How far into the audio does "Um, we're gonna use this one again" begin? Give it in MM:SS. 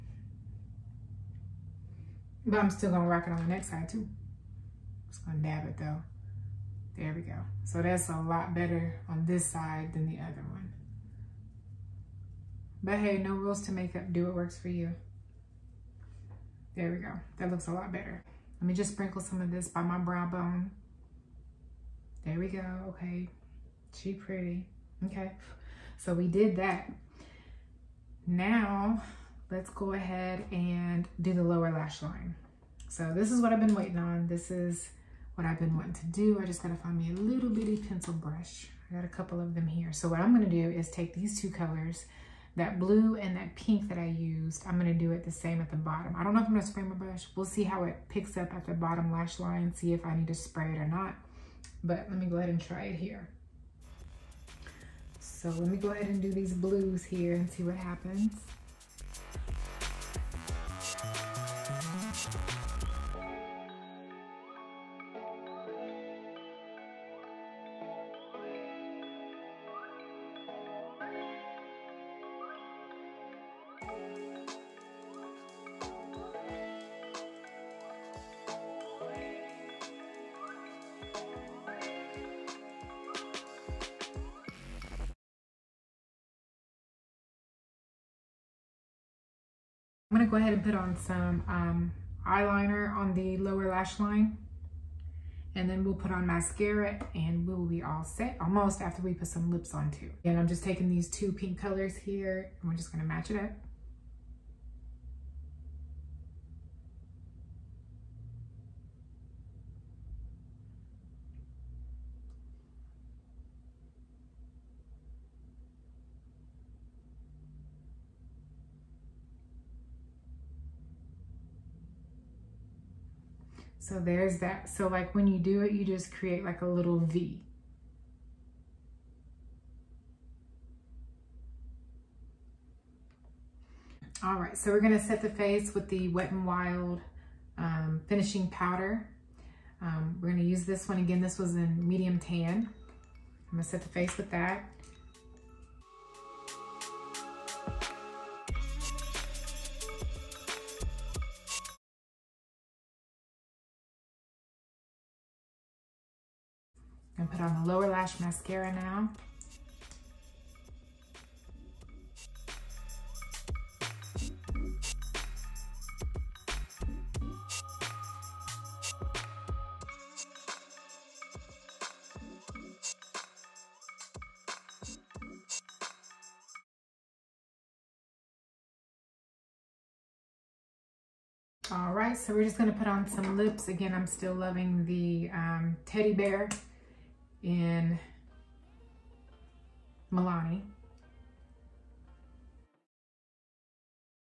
02:19.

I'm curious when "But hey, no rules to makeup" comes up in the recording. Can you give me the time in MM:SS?
00:12.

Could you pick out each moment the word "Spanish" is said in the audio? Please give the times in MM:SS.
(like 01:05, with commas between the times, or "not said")
not said.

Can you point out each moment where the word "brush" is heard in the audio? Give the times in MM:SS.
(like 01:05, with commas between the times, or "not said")
00:38, 00:46.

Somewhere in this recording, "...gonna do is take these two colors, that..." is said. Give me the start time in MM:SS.
00:40.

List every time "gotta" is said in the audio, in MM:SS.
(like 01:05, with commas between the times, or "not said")
00:36.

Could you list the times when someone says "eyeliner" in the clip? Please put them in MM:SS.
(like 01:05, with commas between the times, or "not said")
01:32.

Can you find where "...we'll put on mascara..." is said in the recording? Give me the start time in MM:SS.
01:35.